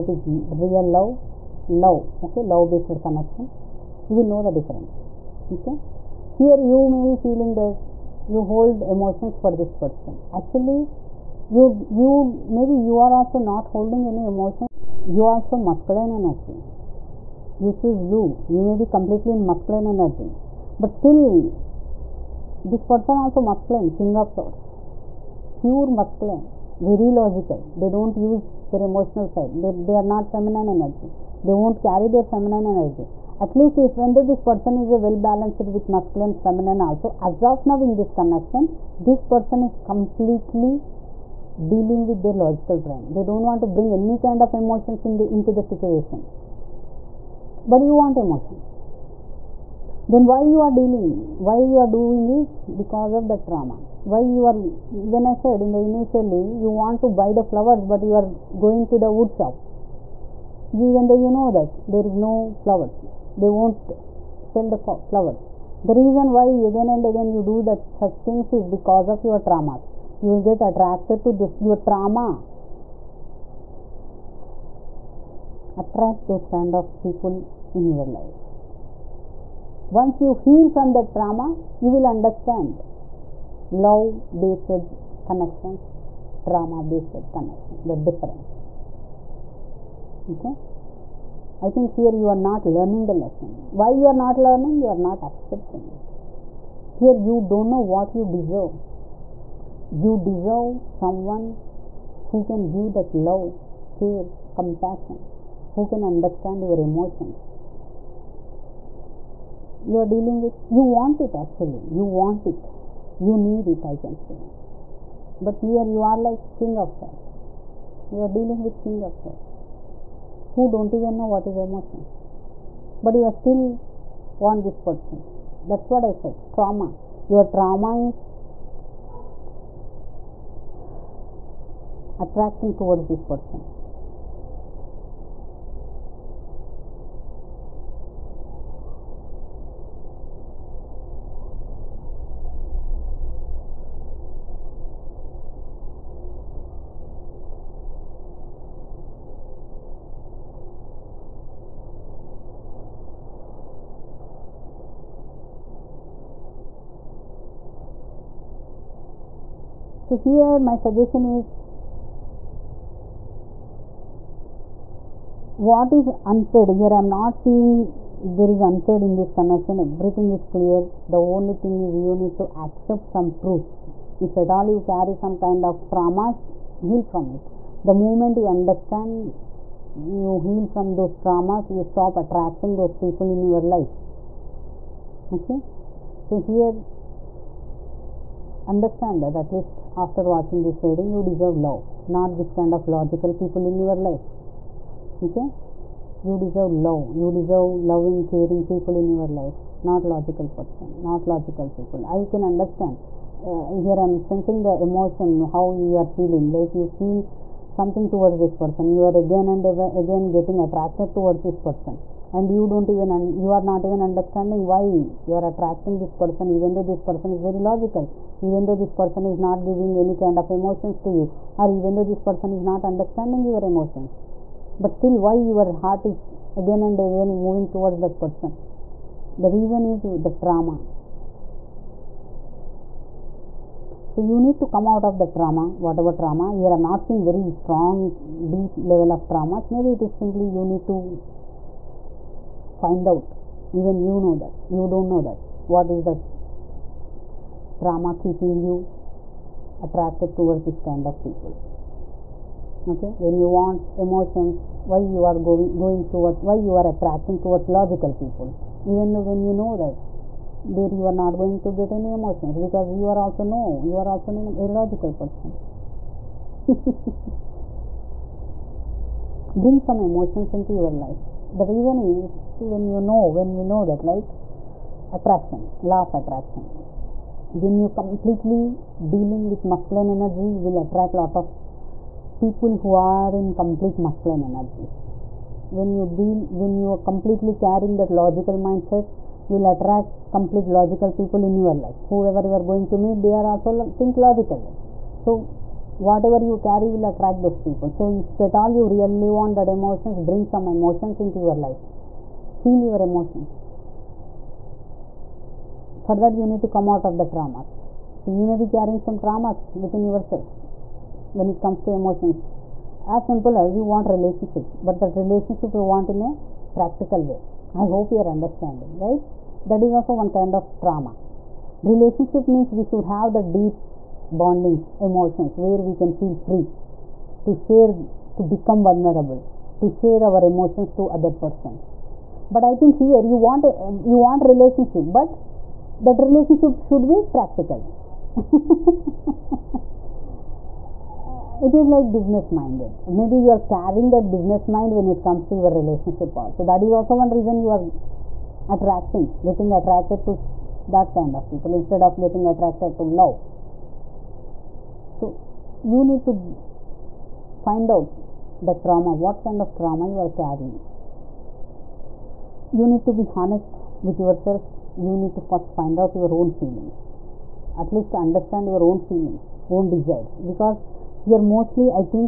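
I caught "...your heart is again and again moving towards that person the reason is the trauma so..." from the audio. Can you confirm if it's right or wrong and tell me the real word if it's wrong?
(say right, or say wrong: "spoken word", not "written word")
right.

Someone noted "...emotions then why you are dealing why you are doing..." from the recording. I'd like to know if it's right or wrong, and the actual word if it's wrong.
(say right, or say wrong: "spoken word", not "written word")
right.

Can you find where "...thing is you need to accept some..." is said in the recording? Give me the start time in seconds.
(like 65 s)
171 s.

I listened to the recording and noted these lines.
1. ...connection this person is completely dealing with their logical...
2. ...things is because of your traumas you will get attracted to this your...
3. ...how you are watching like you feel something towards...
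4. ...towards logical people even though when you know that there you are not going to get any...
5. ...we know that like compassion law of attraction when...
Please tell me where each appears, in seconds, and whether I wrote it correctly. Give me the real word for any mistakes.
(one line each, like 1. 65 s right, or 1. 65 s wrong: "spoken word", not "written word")
1. 38 s right
2. 68 s right
3. 205 s wrong: "feeling", not "watching"
4. 257 s right
5. 273 s wrong: "attraction", not "compassion".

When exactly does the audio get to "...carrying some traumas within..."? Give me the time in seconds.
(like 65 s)
308 s.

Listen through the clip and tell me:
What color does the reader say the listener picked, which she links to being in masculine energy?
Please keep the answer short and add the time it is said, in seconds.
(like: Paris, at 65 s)
Blue, at 18 s.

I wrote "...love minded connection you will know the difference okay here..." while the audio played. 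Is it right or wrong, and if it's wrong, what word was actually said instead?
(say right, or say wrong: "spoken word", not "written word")
wrong: "based", not "minded".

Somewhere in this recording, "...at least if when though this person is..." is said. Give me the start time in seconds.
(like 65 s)
33 s.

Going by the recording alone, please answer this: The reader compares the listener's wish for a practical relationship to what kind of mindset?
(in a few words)
Business minded.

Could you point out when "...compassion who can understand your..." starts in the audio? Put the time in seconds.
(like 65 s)
104 s.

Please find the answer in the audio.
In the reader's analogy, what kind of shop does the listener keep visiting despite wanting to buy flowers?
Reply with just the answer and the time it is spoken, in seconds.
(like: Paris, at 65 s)
Wood shop, at 59 s.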